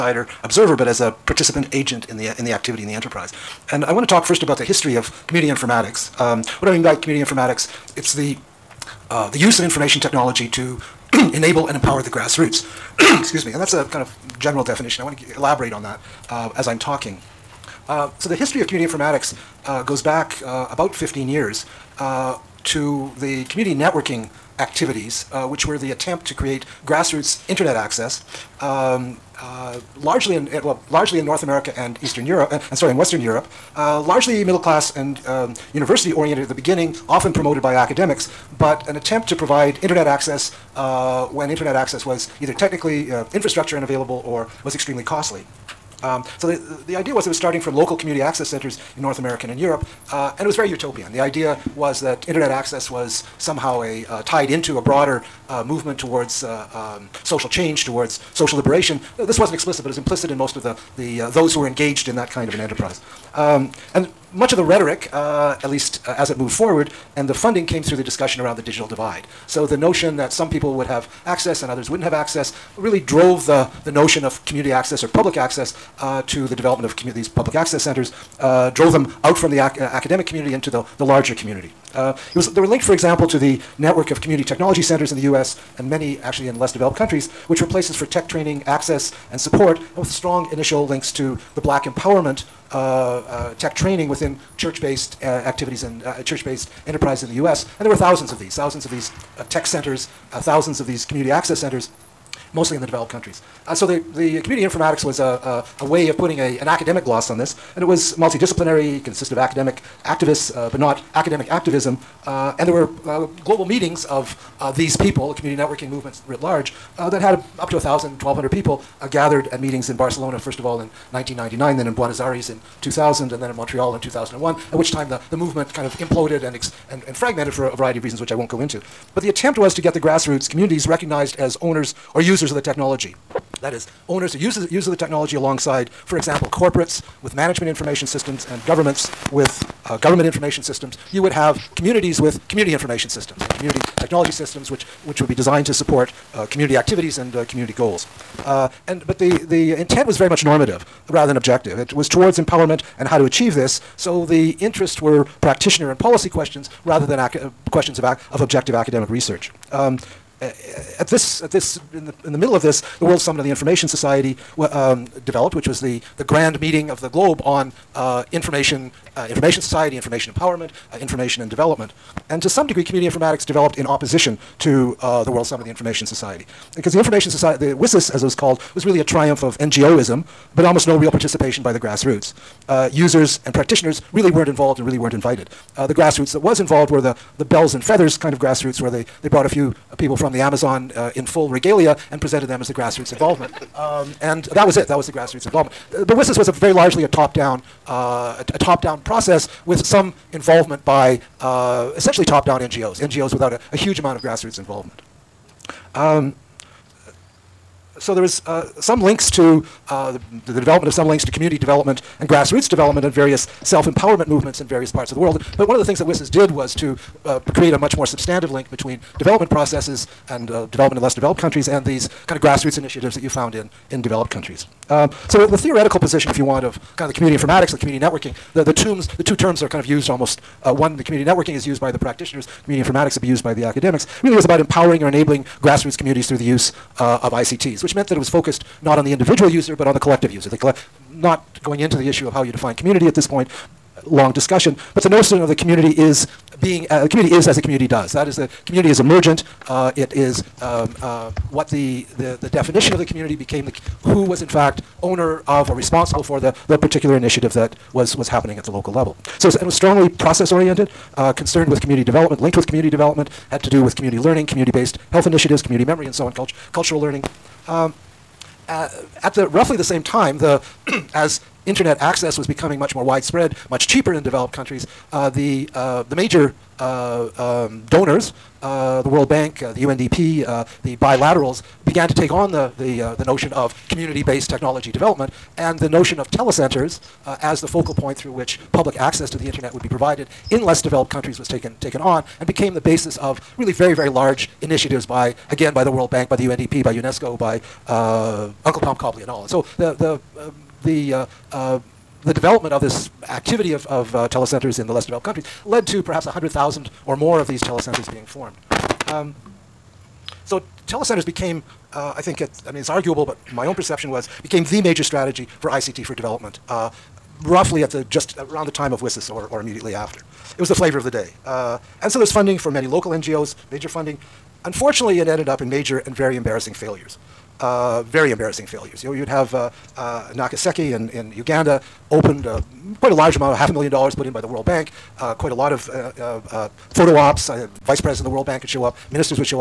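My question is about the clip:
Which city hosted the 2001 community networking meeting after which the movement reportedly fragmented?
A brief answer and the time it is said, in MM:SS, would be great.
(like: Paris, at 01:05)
Montreal, at 02:03.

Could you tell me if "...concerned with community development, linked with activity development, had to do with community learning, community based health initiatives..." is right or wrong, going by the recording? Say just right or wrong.
wrong.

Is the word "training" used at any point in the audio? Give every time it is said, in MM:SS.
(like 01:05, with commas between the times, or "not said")
01:28, 01:33.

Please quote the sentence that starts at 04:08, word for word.
That is, the community is emergent.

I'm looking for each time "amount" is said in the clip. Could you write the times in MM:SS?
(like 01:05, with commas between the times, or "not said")
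03:23, 05:33.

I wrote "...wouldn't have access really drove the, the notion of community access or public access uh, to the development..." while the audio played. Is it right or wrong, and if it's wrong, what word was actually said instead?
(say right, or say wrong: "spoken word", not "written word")
right.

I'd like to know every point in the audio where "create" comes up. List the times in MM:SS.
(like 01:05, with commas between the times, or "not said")
00:26, 03:37.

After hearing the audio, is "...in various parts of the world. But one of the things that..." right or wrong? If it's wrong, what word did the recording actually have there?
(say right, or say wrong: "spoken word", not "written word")
right.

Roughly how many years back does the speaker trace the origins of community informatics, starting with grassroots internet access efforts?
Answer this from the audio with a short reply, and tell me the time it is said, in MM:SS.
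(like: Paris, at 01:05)
15 years, at 00:20.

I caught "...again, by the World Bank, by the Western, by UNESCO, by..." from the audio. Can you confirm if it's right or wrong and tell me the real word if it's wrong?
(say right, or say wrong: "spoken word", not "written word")
wrong: "UNDP", not "Western".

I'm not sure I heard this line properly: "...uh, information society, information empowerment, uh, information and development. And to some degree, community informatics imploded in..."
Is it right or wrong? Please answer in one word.
wrong.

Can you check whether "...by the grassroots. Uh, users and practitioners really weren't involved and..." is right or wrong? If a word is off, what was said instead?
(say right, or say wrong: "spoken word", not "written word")
right.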